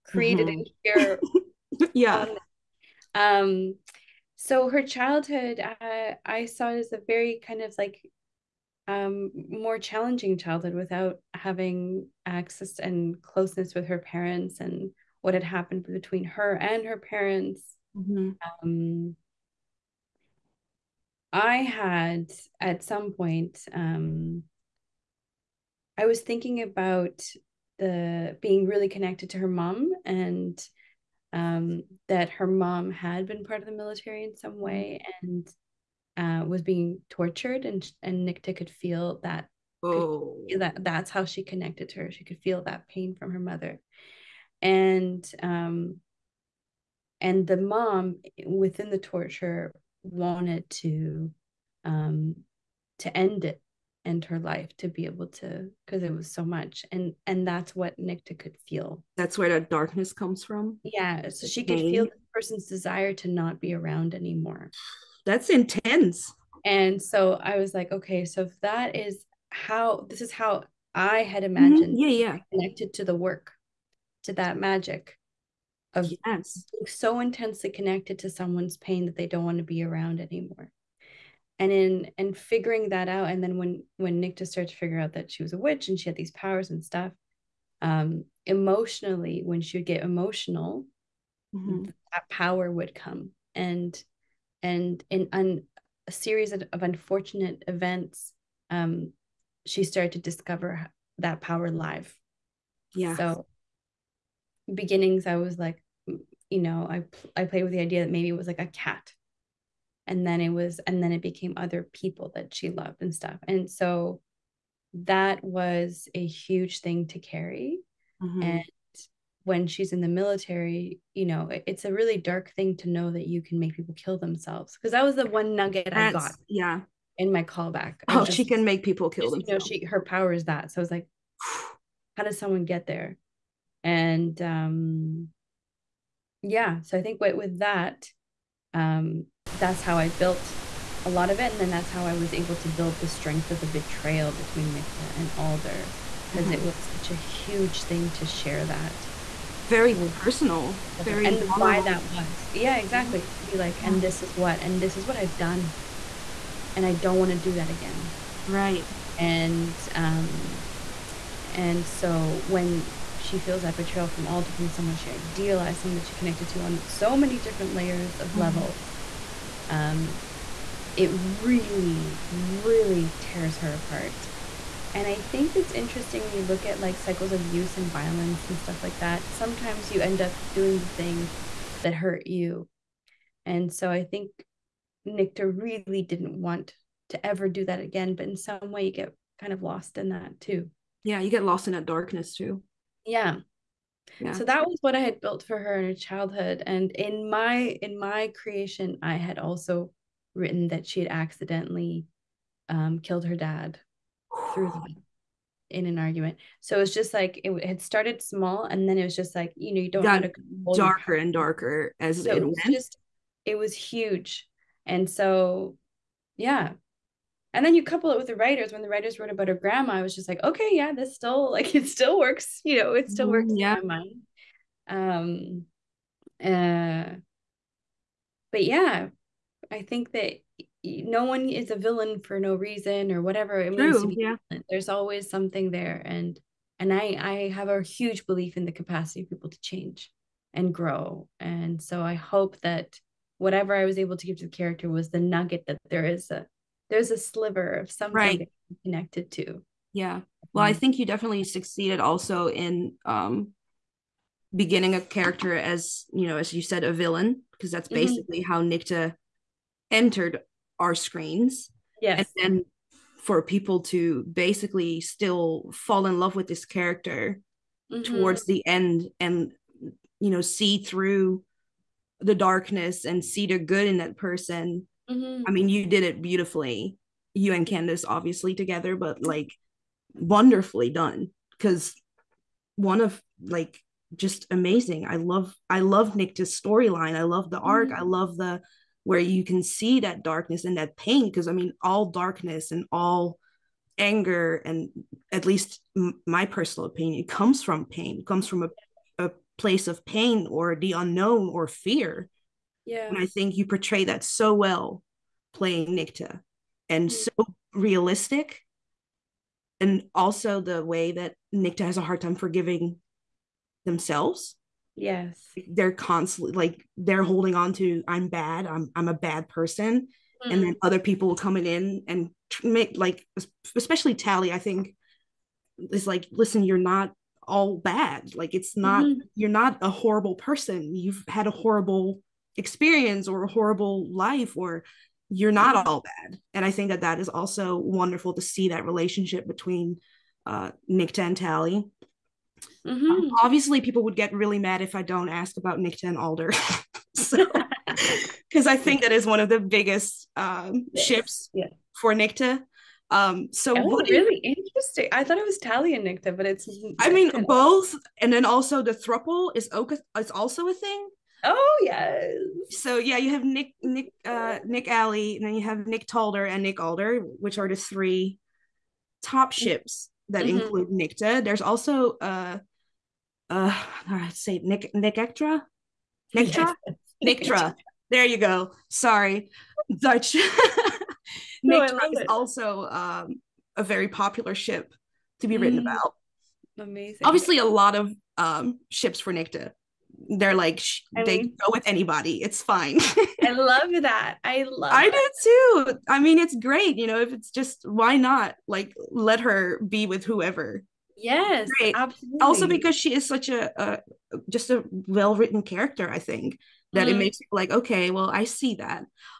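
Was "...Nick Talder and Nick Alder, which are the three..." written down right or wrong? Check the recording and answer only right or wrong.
right.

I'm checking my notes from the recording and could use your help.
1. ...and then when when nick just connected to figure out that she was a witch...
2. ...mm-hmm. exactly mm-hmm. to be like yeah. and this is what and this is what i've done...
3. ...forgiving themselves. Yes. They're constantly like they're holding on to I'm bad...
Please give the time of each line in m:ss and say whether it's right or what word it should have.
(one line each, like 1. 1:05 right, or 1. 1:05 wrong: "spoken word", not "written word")
1. 1:23 wrong: "started", not "connected"
2. 2:32 right
3. 5:12 right.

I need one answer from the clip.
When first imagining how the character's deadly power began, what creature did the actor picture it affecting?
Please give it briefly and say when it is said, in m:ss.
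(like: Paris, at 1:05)
a cat, at 1:48.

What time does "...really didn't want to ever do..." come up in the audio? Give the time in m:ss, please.
3:05.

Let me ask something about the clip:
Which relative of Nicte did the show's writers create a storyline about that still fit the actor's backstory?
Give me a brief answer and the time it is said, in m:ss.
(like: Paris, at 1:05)
her grandma, at 3:39.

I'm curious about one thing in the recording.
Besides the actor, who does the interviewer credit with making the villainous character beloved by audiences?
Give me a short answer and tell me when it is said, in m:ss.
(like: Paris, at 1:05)
Candace, at 4:37.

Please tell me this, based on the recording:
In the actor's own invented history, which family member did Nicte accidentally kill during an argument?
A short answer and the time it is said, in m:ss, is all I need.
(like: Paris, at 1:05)
her dad, at 3:23.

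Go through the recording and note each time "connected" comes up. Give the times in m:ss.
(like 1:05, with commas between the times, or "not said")
0:28, 0:41, 1:12, 1:17, 2:46, 4:08.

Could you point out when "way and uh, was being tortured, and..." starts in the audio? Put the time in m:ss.
0:34.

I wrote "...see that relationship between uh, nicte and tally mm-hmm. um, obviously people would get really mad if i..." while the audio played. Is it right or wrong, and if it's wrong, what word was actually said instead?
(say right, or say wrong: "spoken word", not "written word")
right.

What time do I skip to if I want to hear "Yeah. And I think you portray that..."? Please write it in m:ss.
5:02.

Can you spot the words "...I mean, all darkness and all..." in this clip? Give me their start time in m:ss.
4:51.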